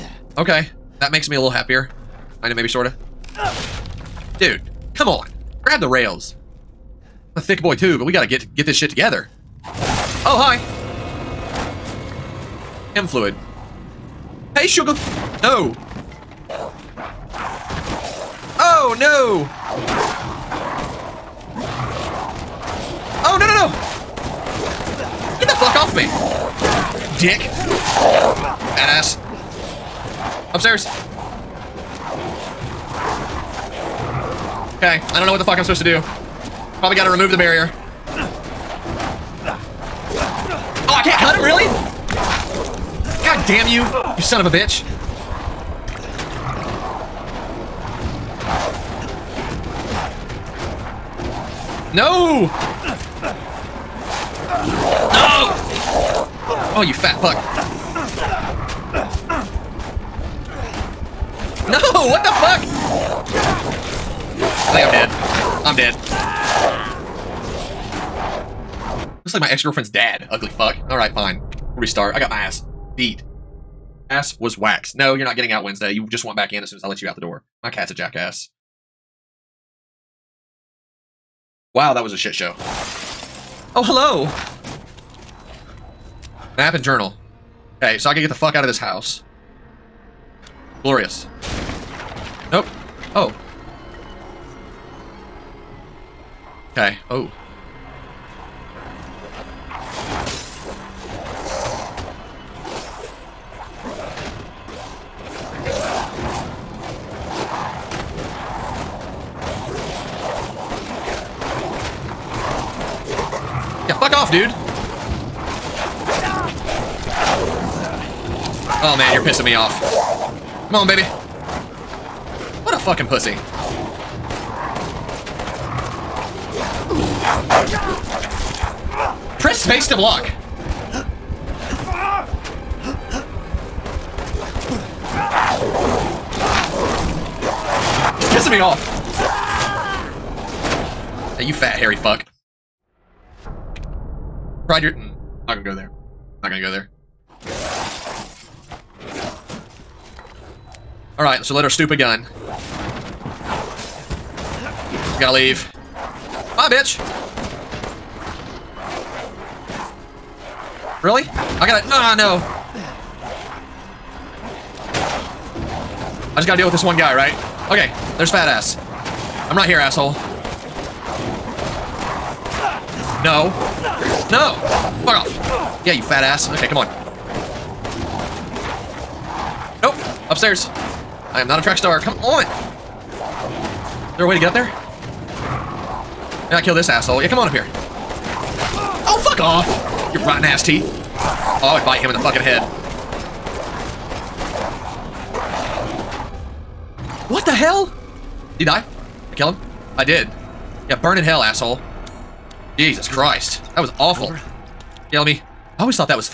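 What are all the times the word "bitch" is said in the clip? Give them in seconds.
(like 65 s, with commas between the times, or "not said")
44 s, 156 s.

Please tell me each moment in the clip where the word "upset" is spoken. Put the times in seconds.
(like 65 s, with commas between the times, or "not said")
not said.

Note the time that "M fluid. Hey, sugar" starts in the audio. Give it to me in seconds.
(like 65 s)
12 s.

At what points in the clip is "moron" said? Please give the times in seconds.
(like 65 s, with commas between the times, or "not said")
not said.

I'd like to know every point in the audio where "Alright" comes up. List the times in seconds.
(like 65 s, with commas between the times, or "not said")
70 s, 151 s.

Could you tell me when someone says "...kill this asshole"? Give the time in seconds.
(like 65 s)
186 s.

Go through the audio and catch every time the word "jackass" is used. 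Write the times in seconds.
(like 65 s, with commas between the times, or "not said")
77 s.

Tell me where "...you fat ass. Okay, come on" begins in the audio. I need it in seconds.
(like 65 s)
175 s.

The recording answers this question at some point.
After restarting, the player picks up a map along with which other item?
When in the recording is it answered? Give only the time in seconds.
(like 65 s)
86 s.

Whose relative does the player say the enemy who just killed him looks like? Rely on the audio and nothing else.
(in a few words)
Ex-girlfriend's dad.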